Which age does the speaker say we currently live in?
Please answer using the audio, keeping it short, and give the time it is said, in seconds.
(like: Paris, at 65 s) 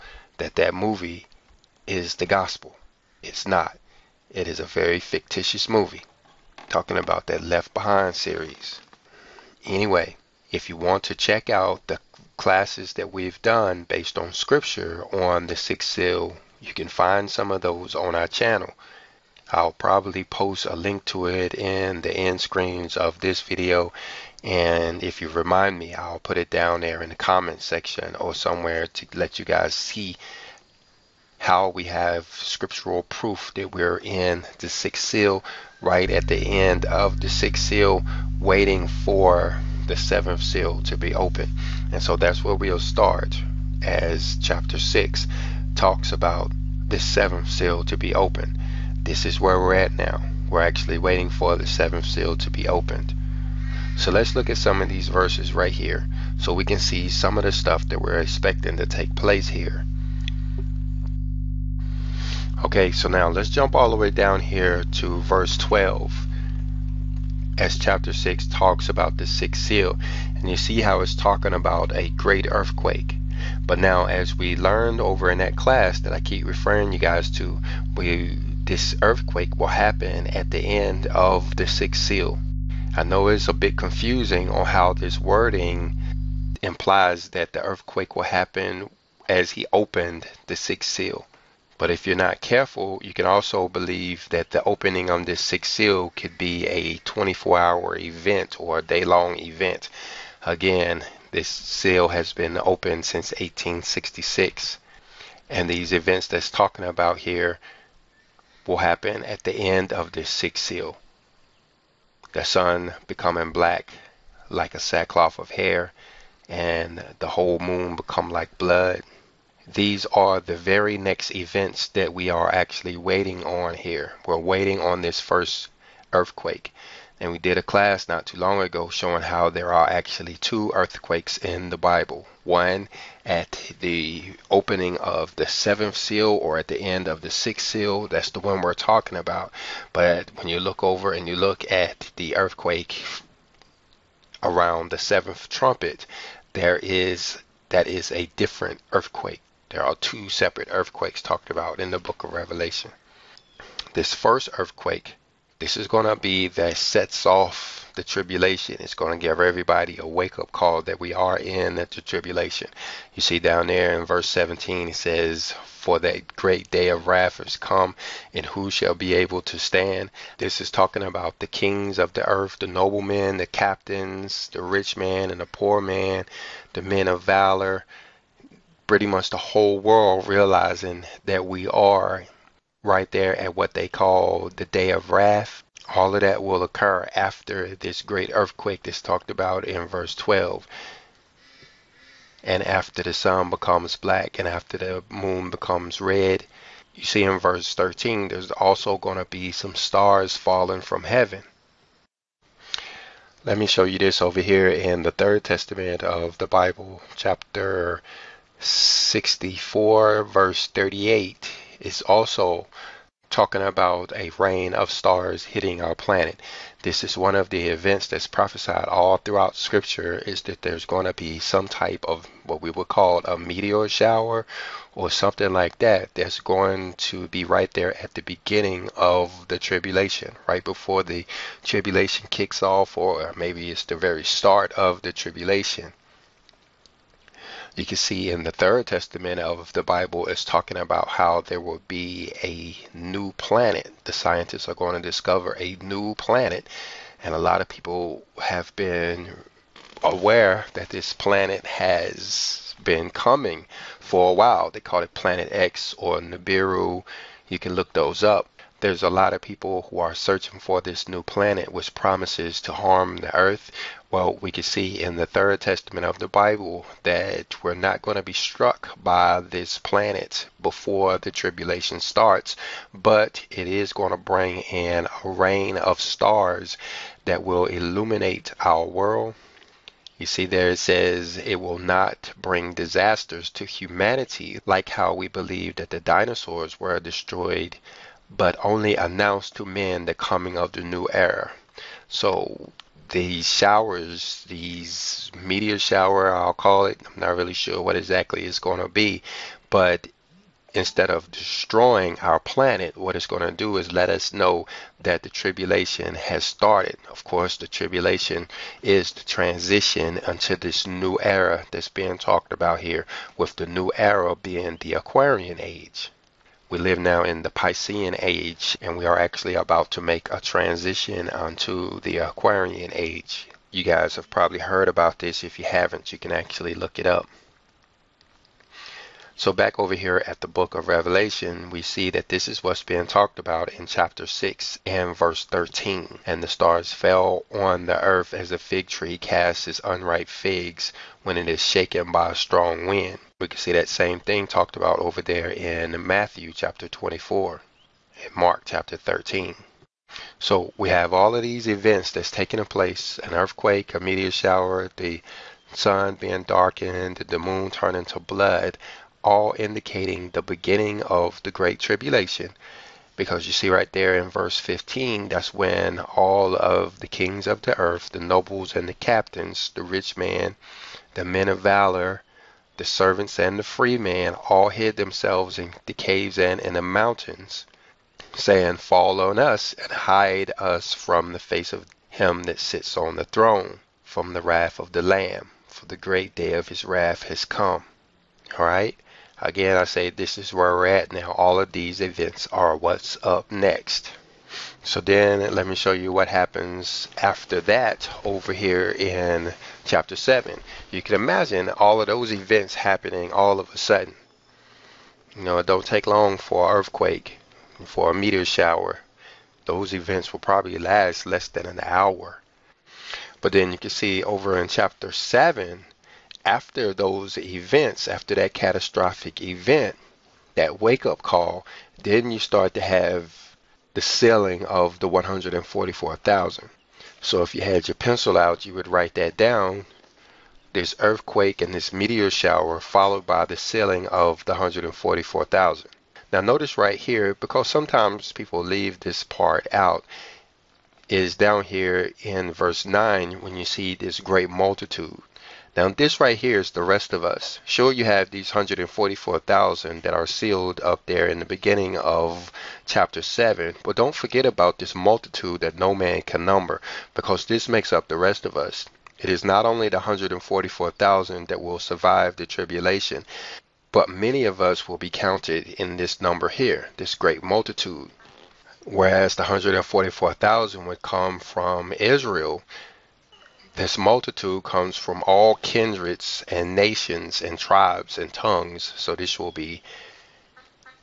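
Piscean age, at 317 s.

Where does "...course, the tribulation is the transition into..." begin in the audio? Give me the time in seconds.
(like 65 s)
307 s.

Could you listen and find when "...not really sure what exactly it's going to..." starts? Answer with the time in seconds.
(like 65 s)
297 s.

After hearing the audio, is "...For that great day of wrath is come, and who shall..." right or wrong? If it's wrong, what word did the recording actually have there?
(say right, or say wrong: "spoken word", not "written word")
right.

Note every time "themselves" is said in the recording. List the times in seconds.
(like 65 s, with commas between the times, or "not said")
374 s.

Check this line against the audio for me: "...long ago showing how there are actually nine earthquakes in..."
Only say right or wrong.
wrong.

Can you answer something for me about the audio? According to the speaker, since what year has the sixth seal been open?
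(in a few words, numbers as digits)
1866.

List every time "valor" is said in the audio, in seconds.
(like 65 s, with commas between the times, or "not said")
177 s, 371 s.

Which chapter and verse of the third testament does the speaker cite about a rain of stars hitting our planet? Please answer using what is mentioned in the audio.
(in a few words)
Chapter 64, verse 38.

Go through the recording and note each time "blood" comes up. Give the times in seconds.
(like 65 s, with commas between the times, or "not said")
118 s, 358 s.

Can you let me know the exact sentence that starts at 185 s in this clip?
All of that will occur after this great earthquake that's talked about in verse 12.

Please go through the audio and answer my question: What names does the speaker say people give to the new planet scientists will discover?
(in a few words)
Planet X or Nibiru.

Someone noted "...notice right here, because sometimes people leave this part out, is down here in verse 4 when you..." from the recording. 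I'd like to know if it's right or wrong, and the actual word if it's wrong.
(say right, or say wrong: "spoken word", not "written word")
wrong: "9", not "4".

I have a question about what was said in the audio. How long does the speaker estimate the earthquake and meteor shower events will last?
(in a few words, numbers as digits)
less than an hour.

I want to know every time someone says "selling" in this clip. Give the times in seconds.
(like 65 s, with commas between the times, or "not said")
424 s, 433 s.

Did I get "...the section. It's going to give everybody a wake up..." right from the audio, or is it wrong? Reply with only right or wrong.
wrong.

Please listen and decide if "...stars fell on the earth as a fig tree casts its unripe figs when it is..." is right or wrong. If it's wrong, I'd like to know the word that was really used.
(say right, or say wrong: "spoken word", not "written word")
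right.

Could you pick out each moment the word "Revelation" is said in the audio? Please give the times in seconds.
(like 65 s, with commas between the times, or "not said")
152 s, 330 s.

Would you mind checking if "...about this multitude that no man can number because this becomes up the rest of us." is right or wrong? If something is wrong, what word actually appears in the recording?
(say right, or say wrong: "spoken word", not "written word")
wrong: "makes", not "becomes".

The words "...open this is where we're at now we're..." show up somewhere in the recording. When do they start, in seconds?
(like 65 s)
48 s.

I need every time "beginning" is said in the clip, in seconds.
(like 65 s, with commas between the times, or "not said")
228 s, 360 s, 451 s.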